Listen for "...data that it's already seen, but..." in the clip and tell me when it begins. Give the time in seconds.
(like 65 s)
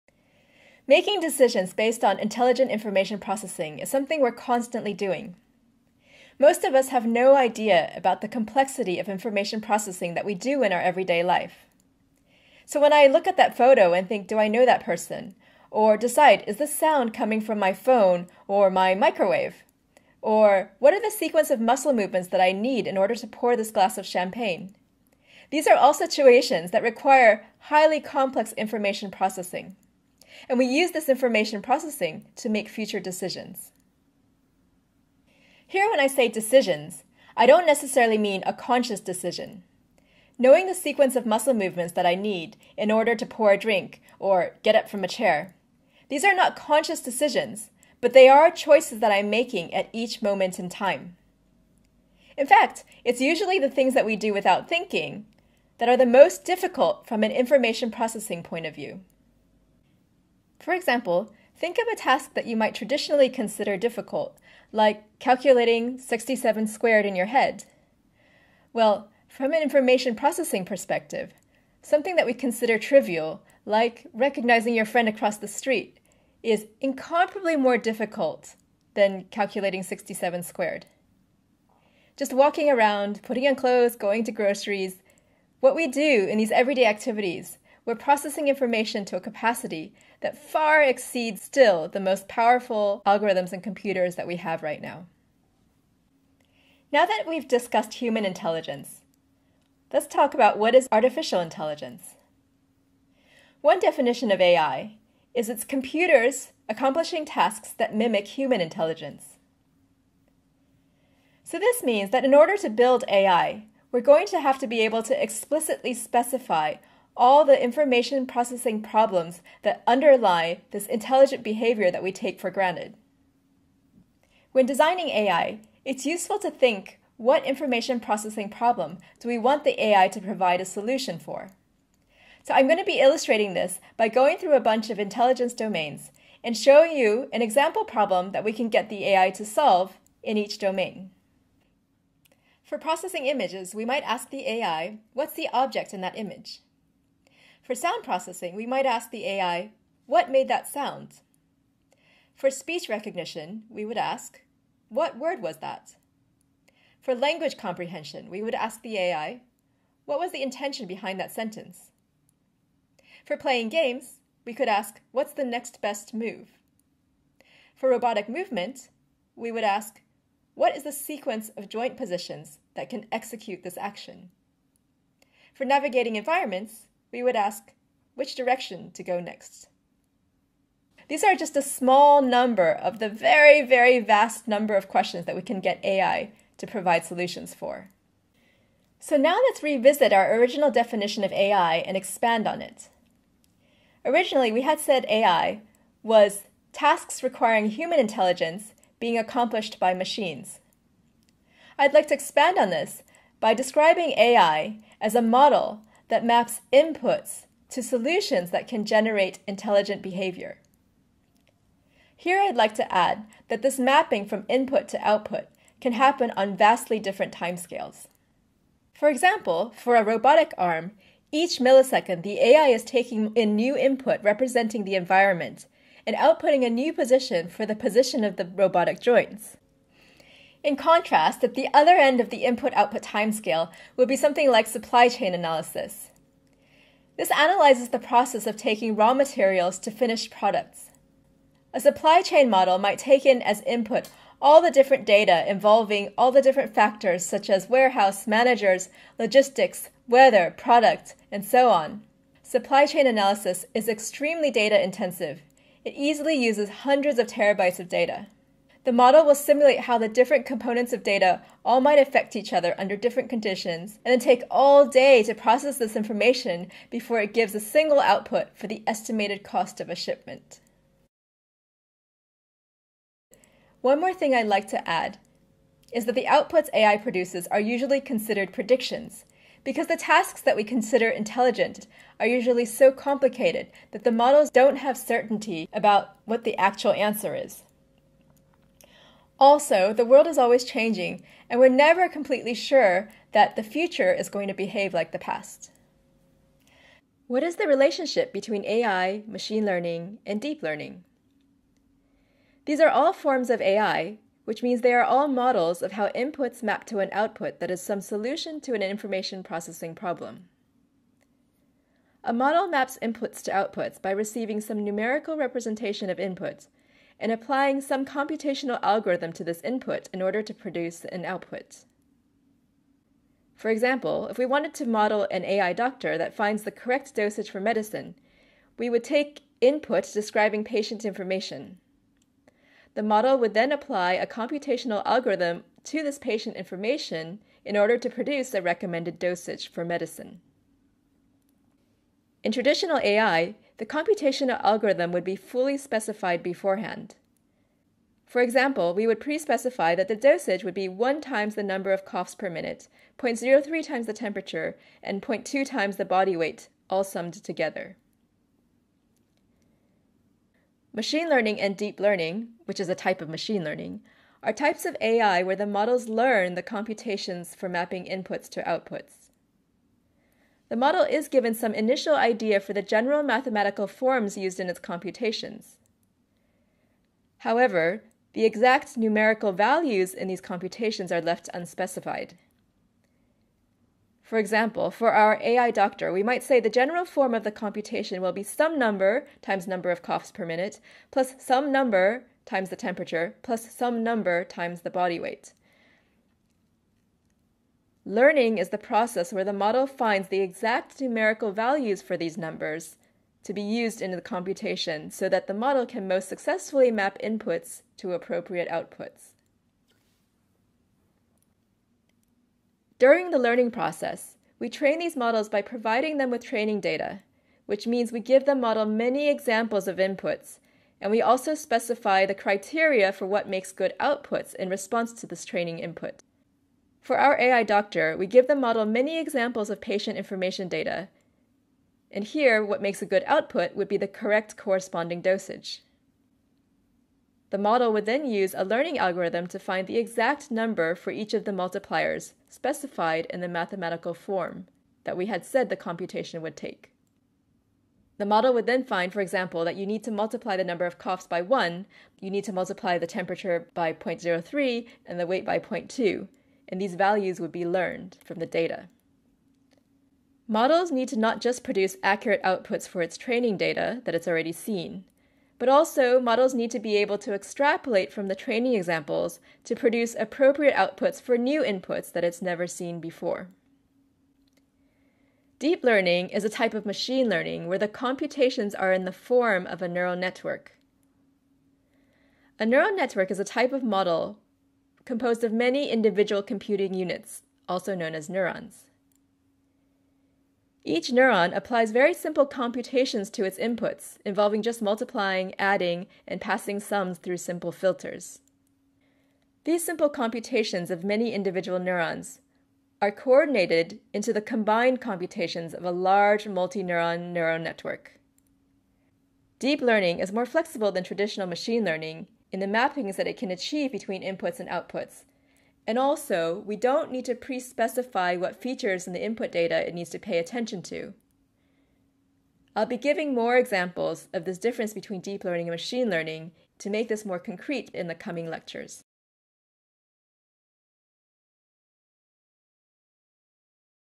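463 s.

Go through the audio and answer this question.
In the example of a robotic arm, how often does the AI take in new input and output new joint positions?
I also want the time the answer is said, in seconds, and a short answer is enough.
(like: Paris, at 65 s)
Each millisecond, at 221 s.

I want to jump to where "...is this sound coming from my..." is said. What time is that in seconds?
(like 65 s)
16 s.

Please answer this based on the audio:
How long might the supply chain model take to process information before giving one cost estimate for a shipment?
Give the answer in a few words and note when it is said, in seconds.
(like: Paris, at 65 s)
All day, at 264 s.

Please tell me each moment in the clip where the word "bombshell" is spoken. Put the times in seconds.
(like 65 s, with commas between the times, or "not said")
not said.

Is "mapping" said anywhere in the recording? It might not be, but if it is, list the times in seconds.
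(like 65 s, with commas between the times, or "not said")
213 s, 367 s, 512 s.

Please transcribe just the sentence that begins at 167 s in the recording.
For robotic movement, we would ask, what is the sequence of joint positions that can execute this action?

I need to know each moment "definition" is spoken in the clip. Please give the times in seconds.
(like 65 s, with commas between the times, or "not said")
103 s, 190 s.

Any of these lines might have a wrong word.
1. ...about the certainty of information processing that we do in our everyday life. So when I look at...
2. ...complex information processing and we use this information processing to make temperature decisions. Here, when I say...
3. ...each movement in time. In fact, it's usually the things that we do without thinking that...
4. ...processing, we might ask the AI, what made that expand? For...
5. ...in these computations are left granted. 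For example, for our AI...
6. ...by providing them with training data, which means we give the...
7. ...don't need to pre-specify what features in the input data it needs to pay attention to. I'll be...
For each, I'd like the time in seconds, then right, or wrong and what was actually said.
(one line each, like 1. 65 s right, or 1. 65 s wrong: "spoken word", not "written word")
1. 7 s wrong: "complexity", not "certainty"
2. 27 s wrong: "future", not "temperature"
3. 49 s wrong: "moment", not "movement"
4. 148 s wrong: "sound", not "expand"
5. 380 s wrong: "unspecified", not "granted"
6. 415 s right
7. 516 s right.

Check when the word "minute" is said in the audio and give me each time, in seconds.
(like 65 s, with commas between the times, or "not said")
352 s, 390 s.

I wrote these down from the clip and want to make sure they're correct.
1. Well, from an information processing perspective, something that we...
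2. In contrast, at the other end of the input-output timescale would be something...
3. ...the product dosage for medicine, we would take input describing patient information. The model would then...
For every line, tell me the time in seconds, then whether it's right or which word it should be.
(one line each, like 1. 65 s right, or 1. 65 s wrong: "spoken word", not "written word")
1. 68 s right
2. 230 s right
3. 326 s wrong: "correct", not "product".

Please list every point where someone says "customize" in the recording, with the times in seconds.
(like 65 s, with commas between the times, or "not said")
not said.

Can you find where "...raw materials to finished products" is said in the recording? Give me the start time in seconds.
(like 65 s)
238 s.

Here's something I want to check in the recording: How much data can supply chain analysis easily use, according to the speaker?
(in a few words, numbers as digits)
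Hundreds of terabytes.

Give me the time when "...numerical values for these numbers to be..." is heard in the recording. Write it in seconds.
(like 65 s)
400 s.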